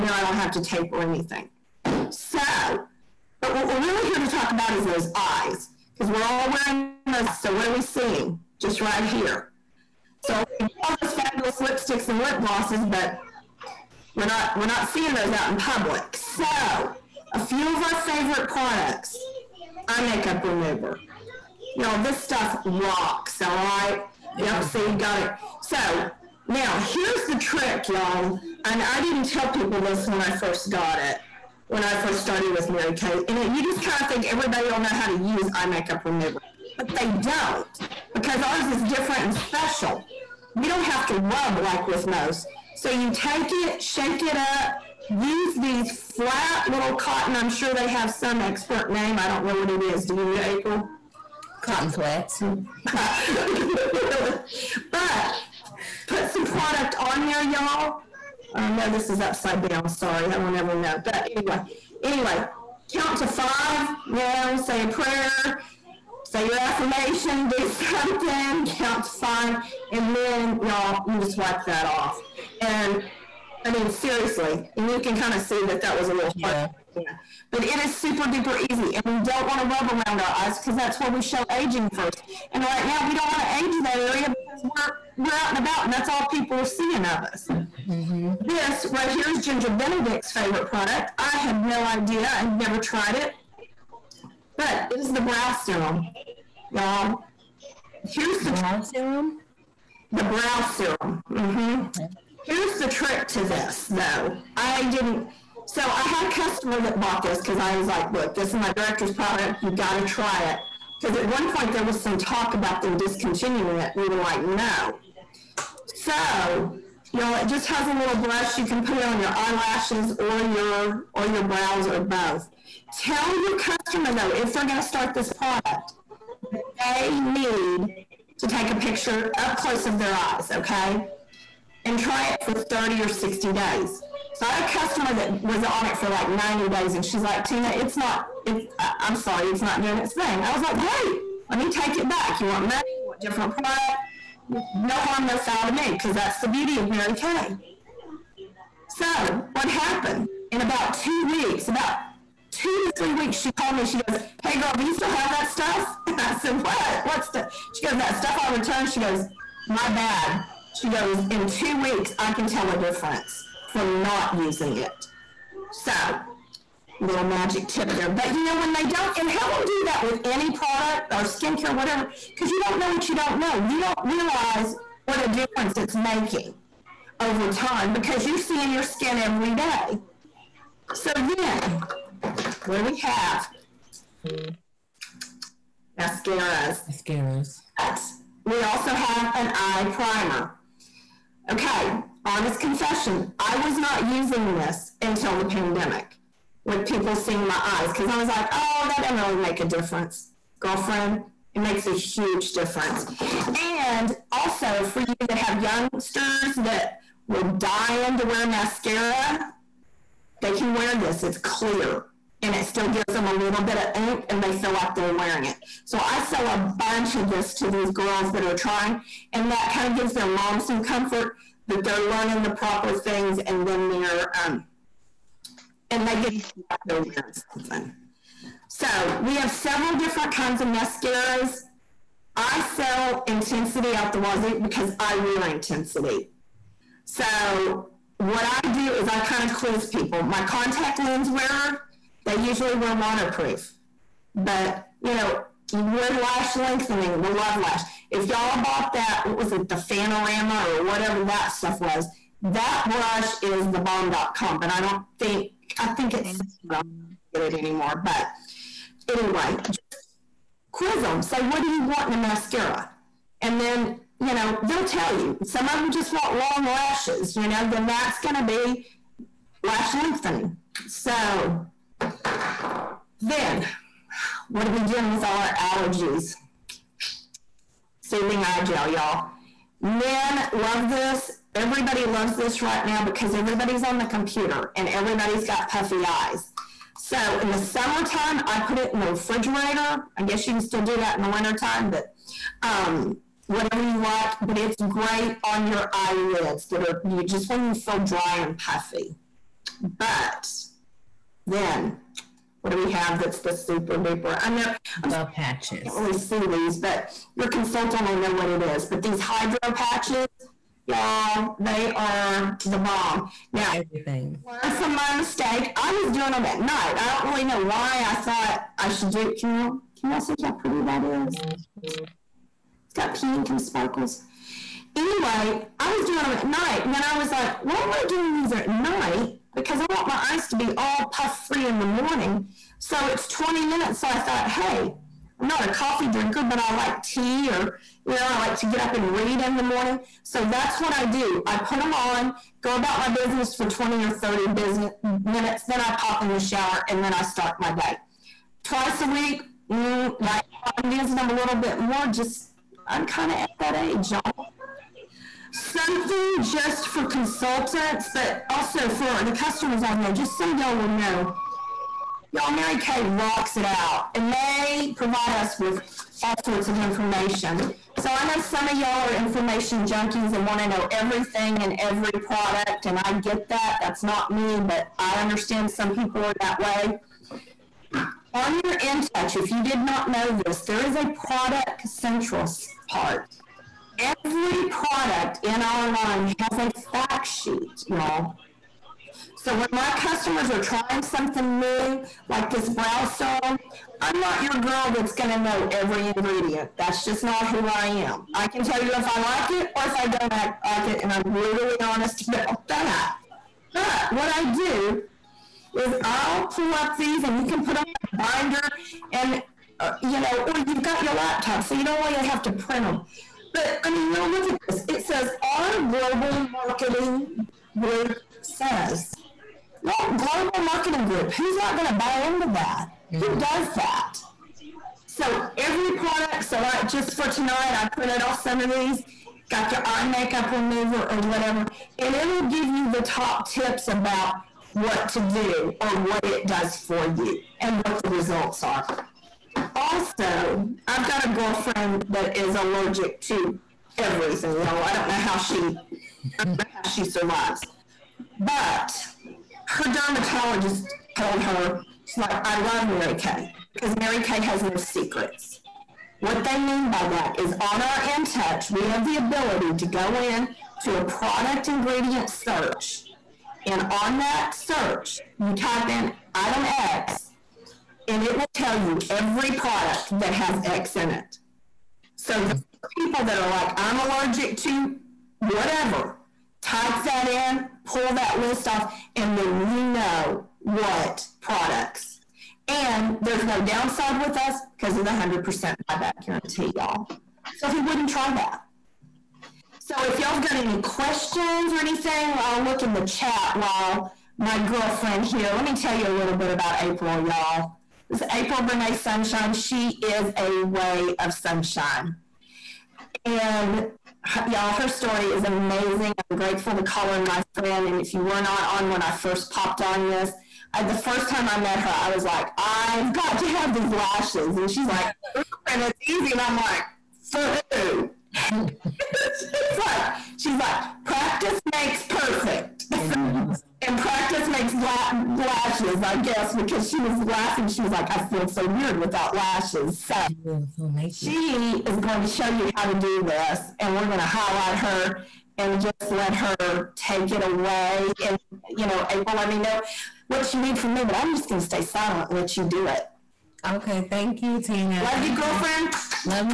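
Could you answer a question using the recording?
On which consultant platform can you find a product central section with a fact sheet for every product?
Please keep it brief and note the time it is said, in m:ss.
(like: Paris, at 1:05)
InTouch, at 6:18.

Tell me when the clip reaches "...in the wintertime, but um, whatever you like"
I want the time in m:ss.
4:51.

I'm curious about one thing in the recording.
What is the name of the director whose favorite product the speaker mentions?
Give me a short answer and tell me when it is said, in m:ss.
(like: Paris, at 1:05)
Ginger Benedict, at 1:29.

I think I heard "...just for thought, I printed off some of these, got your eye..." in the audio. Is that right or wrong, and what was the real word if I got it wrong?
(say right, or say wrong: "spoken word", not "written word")
wrong: "tonight", not "thought".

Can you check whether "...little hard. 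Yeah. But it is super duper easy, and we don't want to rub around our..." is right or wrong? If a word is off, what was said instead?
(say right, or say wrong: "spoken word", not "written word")
right.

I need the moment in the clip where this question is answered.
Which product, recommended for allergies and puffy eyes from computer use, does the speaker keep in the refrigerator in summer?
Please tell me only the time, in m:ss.
4:38.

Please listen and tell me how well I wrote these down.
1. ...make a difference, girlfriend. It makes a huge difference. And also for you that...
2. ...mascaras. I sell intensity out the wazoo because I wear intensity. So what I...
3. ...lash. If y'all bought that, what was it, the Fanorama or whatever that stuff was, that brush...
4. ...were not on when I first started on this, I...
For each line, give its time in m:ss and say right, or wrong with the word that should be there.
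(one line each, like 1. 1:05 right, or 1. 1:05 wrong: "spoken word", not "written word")
1. 3:19 right
2. 3:50 right
3. 4:07 right
4. 8:28 wrong: "popped", not "started".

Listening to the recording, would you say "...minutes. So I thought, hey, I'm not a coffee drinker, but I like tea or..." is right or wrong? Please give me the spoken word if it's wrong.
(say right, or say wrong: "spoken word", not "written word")
right.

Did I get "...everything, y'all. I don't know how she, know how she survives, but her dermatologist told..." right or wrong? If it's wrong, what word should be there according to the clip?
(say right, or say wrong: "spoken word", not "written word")
right.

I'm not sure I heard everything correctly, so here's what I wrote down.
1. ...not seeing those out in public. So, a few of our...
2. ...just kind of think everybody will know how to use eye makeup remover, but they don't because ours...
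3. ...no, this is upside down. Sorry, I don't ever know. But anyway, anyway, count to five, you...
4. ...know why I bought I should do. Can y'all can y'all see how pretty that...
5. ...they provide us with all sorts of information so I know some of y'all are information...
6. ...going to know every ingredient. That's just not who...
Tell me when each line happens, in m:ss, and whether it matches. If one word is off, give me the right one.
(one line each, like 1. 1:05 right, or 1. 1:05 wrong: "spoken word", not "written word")
1. 0:14 right
2. 0:33 right
3. 0:58 right
4. 5:17 wrong: "thought", not "bought"
5. 6:04 right
6. 6:35 right.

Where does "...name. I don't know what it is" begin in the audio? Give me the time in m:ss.
0:48.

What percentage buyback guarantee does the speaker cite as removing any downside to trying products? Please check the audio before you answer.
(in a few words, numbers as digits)
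100%.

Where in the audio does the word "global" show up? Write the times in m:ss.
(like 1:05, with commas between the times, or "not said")
6:55, 7:00.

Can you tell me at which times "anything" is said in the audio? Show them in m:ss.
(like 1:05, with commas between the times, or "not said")
0:01, 8:11.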